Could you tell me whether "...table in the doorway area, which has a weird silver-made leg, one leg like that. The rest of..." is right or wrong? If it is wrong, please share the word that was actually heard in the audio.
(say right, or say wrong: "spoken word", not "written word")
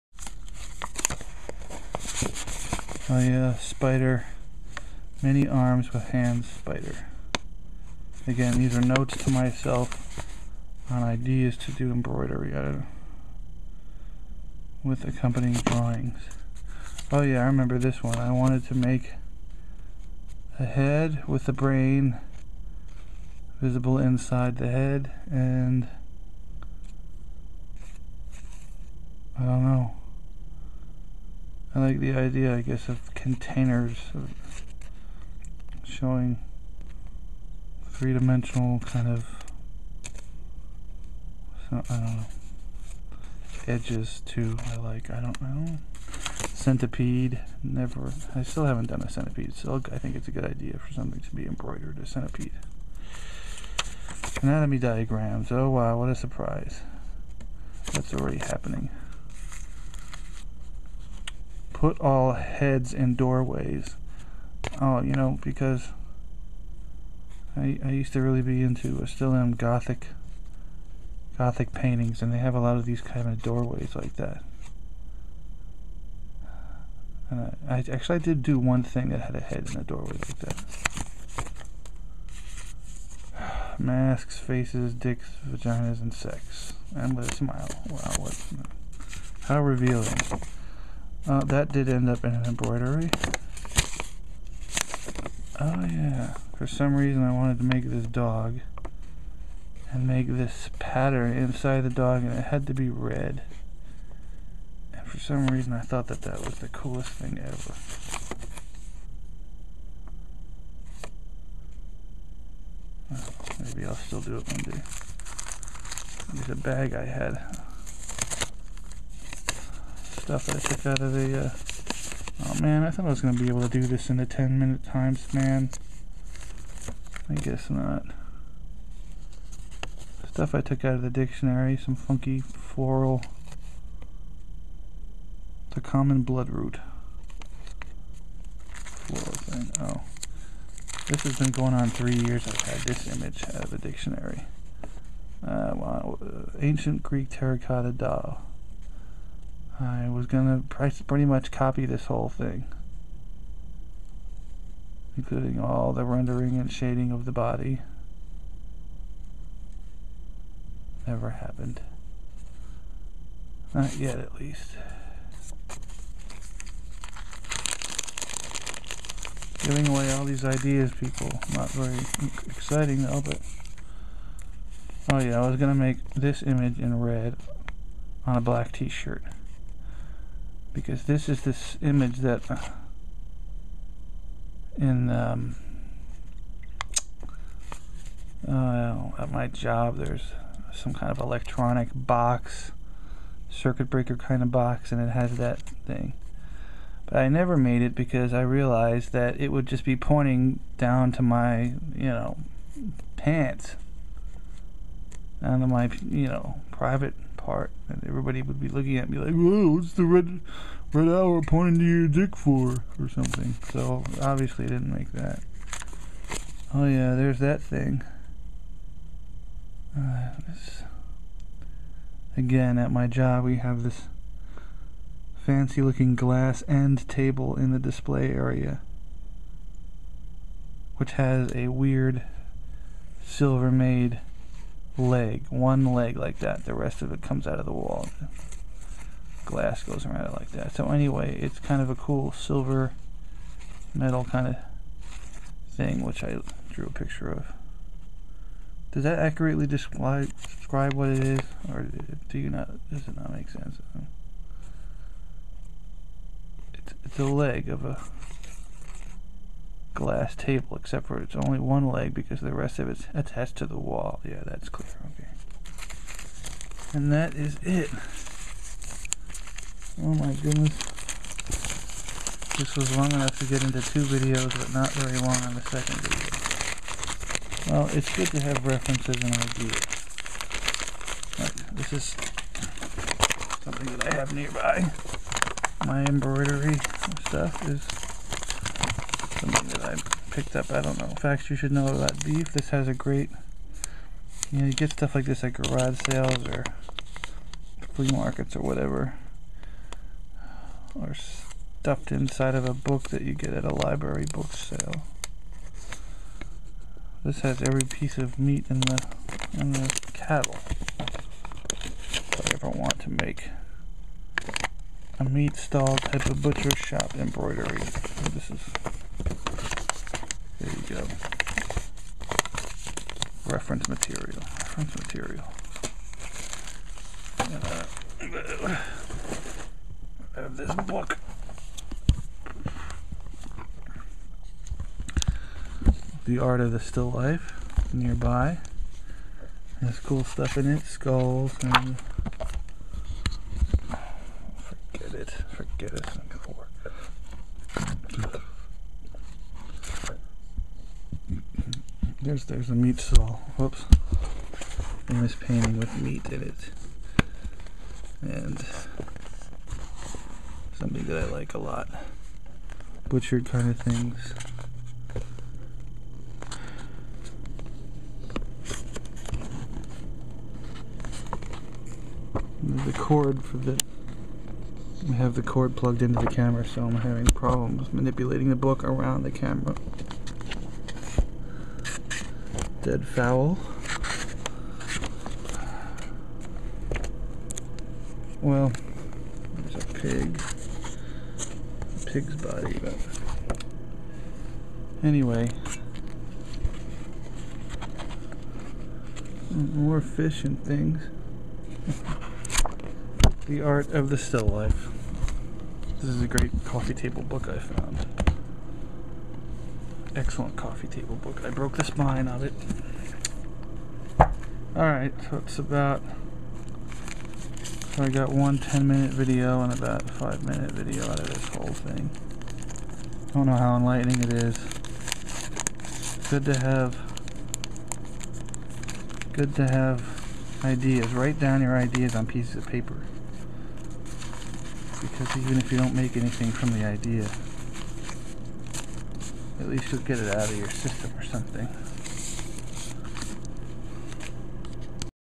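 wrong: "display", not "doorway".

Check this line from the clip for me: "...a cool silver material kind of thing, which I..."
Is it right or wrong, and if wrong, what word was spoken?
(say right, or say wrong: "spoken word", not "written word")
wrong: "metal", not "material".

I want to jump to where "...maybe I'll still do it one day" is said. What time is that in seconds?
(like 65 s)
113 s.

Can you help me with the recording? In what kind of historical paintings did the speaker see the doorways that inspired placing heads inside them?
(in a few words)
Gothic paintings.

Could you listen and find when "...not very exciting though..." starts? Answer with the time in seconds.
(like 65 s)
171 s.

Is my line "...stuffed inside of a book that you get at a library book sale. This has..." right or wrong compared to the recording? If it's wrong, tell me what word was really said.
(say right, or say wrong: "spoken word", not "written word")
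right.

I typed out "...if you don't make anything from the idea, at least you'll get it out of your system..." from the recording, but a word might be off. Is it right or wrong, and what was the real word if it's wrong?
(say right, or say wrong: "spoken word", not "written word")
right.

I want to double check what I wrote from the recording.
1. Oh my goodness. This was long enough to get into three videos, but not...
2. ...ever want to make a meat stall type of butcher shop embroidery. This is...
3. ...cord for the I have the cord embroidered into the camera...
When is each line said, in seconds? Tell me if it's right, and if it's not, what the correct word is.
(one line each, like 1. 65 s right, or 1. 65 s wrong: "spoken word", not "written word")
1. 270 s wrong: "two", not "three"
2. 312 s right
3. 372 s wrong: "plugged", not "embroidered".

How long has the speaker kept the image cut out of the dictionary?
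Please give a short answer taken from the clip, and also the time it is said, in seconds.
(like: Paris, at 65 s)
3 years, at 141 s.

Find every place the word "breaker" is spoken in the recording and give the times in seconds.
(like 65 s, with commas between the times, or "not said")
193 s.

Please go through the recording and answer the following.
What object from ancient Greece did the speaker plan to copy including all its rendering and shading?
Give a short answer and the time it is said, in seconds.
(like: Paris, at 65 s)
terracotta doll, at 147 s.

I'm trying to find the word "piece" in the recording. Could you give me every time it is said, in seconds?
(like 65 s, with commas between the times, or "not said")
307 s, 432 s.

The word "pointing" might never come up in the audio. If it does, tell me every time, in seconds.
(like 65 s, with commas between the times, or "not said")
199 s, 211 s.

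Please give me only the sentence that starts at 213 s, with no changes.
So obviously, I didn't make that.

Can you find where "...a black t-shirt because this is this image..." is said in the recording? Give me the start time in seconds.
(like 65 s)
178 s.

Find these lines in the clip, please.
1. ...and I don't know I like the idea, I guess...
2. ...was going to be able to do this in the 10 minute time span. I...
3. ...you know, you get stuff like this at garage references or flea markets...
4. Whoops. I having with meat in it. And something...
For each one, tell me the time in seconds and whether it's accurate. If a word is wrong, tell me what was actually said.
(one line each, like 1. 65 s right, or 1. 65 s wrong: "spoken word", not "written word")
1. 25 s right
2. 123 s right
3. 294 s wrong: "sales", not "references"
4. 353 s wrong: "painting", not "having".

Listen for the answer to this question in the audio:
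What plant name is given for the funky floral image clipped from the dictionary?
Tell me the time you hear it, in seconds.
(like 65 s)
135 s.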